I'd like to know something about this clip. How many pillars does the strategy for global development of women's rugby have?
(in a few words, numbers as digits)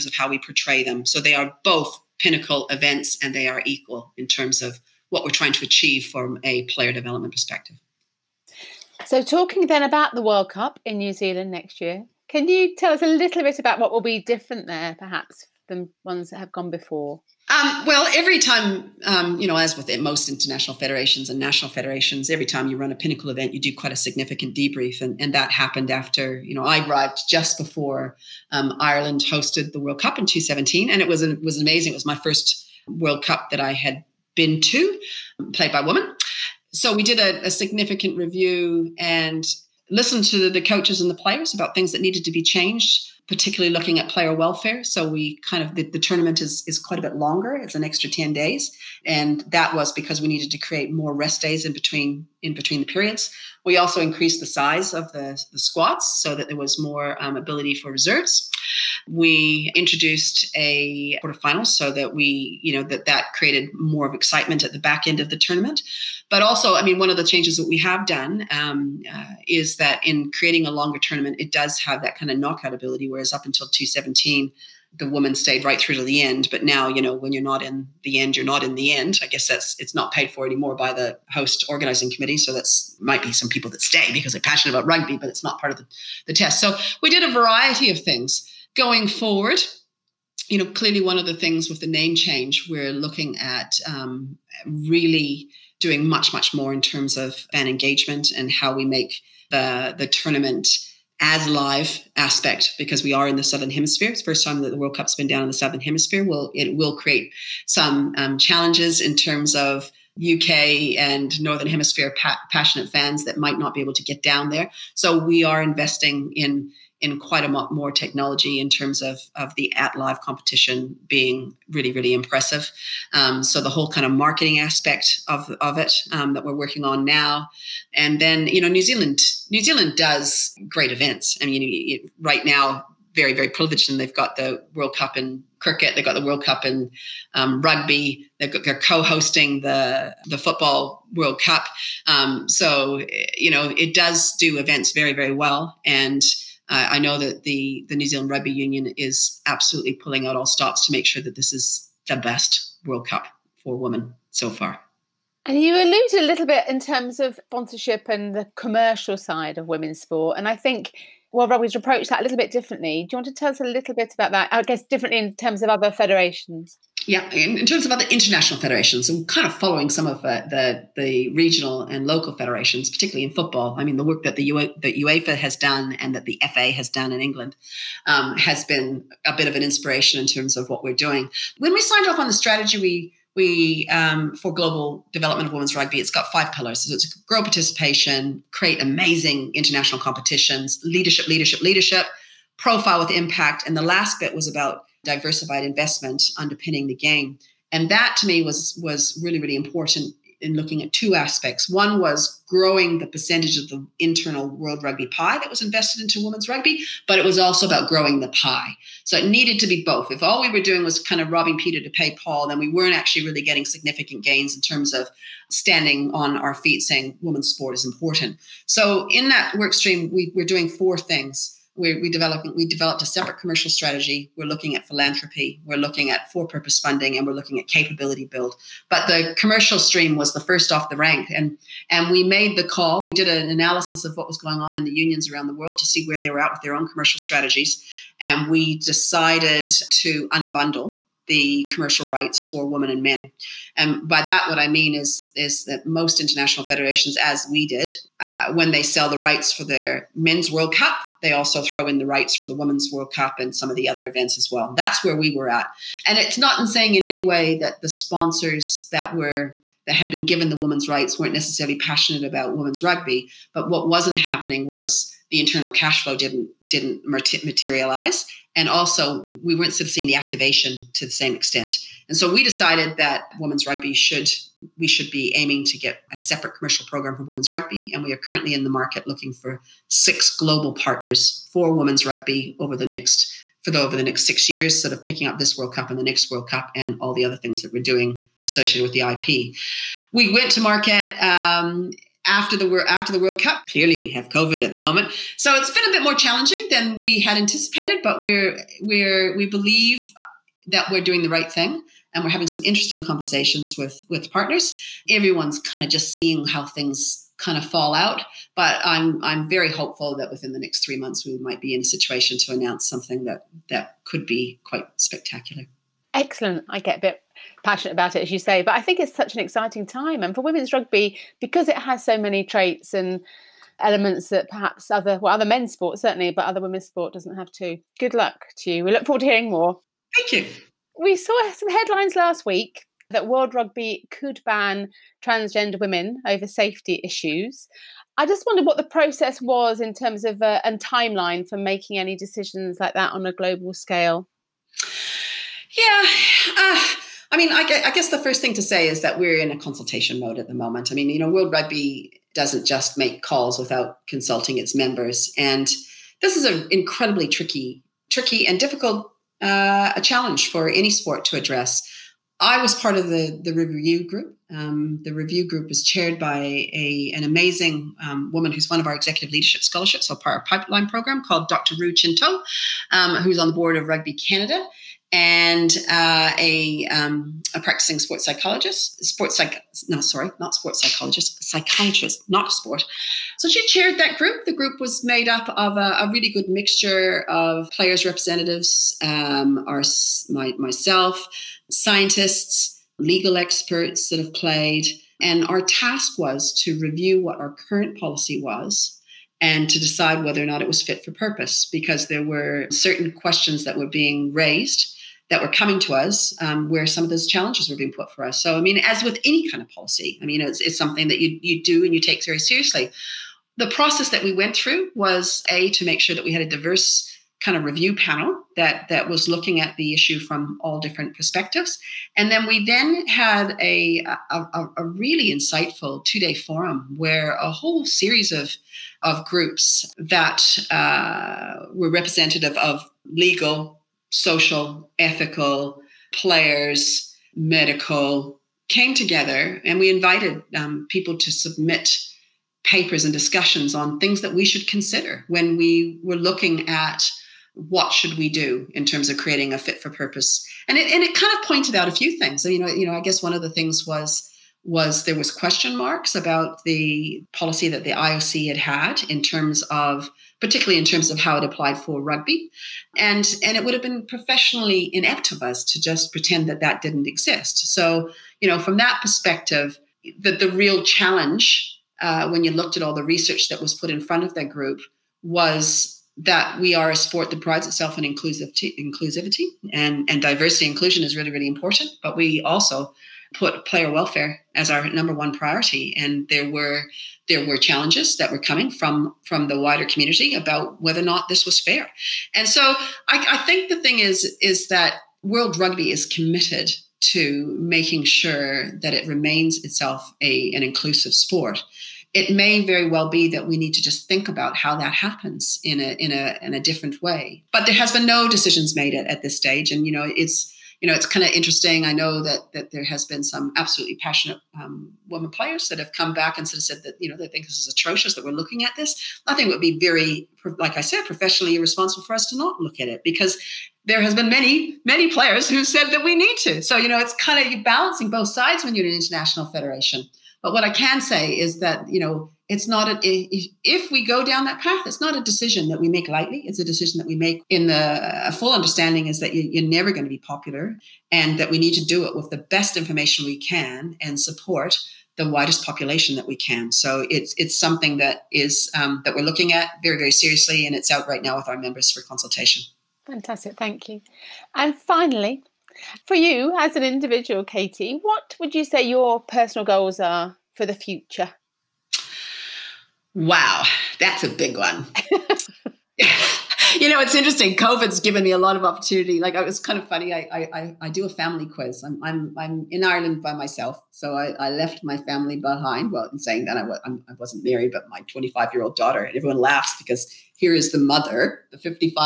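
5.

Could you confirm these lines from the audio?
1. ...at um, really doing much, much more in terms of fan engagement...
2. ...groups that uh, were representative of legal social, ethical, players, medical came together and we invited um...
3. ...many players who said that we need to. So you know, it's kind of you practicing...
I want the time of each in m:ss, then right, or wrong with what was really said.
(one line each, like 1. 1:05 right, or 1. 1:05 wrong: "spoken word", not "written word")
1. 1:33 right
2. 7:09 right
3. 8:44 wrong: "balancing", not "practicing".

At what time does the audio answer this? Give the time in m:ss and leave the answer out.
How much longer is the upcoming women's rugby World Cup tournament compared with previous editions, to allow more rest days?
0:47.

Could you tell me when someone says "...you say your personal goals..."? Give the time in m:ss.
9:18.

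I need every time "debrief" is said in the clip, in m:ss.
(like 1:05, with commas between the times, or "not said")
0:24.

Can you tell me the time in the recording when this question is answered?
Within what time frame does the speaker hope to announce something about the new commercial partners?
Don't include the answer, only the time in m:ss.
5:10.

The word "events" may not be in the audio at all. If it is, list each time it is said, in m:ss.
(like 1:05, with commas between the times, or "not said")
0:02, 0:23, 2:10, 2:24, 4:14.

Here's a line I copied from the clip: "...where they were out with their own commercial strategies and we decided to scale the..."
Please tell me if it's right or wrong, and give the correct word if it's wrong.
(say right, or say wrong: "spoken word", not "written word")
wrong: "unbundle", not "scale".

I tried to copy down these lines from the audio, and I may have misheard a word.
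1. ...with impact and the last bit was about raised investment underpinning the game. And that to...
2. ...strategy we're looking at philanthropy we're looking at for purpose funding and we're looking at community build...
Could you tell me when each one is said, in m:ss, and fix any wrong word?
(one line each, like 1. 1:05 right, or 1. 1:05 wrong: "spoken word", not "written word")
1. 3:12 wrong: "diversified", not "raised"
2. 3:43 wrong: "capability", not "community".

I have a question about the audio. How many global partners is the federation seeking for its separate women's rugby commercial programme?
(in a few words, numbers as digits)
6.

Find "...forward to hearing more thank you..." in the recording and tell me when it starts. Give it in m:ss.
5:29.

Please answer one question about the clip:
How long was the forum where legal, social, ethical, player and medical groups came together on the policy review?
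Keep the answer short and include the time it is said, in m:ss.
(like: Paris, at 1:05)
2 days, at 7:06.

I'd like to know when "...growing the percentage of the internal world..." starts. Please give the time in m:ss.
3:22.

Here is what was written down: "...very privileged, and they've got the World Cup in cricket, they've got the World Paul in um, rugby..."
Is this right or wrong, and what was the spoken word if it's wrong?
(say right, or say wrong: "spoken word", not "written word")
wrong: "Cup", not "Paul".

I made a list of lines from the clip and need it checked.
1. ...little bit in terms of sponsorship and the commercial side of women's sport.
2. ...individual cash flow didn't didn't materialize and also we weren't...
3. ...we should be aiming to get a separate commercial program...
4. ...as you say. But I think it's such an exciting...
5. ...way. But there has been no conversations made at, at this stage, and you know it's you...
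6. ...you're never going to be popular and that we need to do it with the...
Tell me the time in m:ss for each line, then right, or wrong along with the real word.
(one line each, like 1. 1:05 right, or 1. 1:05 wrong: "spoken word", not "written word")
1. 2:36 right
2. 4:25 wrong: "internal", not "individual"
3. 4:34 right
4. 5:18 right
5. 8:27 wrong: "decisions", not "conversations"
6. 8:59 right.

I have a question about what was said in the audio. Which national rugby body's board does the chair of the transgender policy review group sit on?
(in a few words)
Rugby Canada.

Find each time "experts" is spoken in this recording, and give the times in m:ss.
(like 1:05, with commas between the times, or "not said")
6:33.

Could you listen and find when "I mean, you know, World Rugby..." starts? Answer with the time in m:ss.
5:50.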